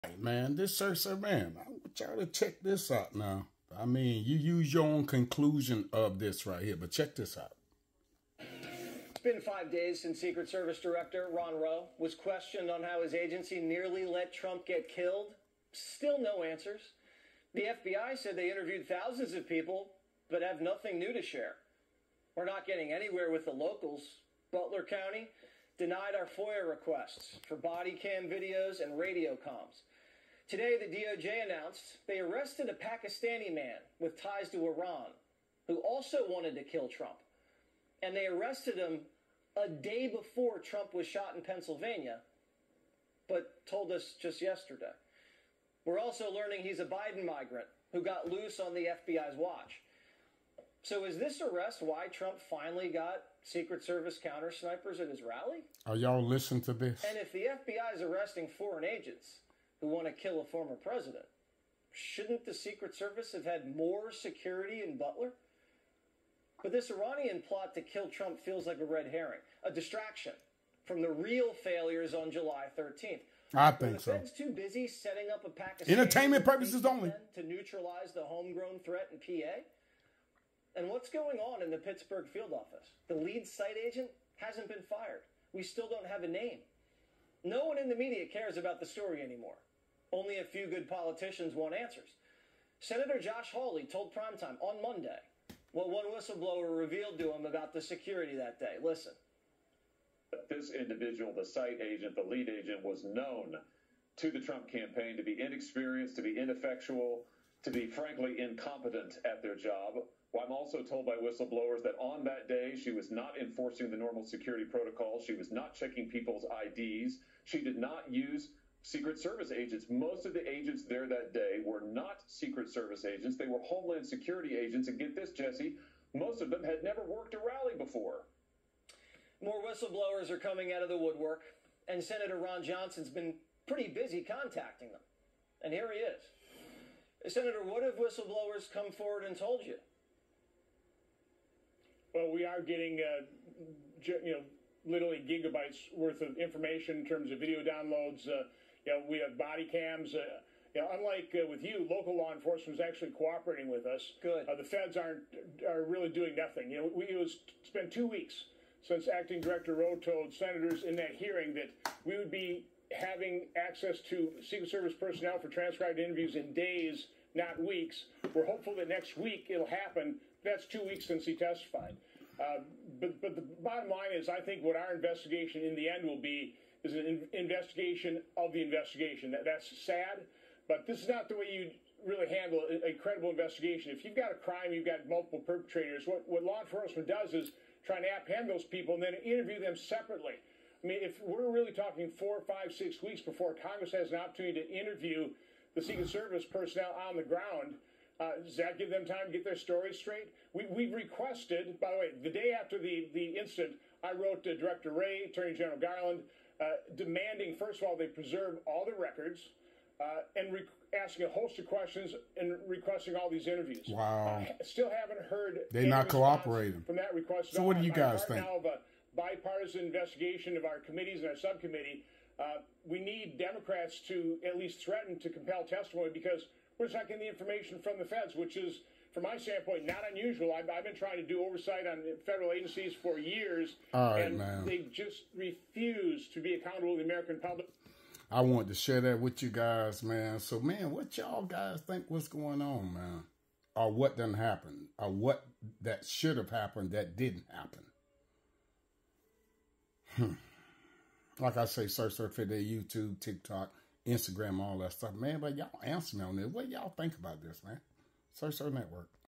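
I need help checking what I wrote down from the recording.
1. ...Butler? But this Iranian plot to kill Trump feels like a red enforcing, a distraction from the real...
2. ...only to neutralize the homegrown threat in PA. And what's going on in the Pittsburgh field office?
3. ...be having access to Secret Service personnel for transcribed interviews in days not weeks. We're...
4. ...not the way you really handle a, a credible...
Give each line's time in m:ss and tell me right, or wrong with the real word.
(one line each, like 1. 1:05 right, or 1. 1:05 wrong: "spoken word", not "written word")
1. 1:04 wrong: "herring", not "enforcing"
2. 1:16 right
3. 2:42 right
4. 3:01 right.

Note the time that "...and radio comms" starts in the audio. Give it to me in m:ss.
0:28.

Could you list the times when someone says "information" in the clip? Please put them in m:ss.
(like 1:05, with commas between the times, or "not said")
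2:26, 3:47.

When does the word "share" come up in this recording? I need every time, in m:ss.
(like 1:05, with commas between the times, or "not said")
0:21, 3:58.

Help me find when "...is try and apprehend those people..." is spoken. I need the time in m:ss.
3:07.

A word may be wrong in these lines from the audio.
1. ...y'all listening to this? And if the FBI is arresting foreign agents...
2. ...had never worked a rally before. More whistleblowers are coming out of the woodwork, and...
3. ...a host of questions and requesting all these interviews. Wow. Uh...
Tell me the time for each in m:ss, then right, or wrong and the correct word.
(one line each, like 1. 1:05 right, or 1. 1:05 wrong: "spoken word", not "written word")
1. 0:55 right
2. 2:06 right
3. 3:31 right.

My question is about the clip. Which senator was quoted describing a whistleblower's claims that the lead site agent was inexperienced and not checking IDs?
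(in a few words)
Josh Hawley.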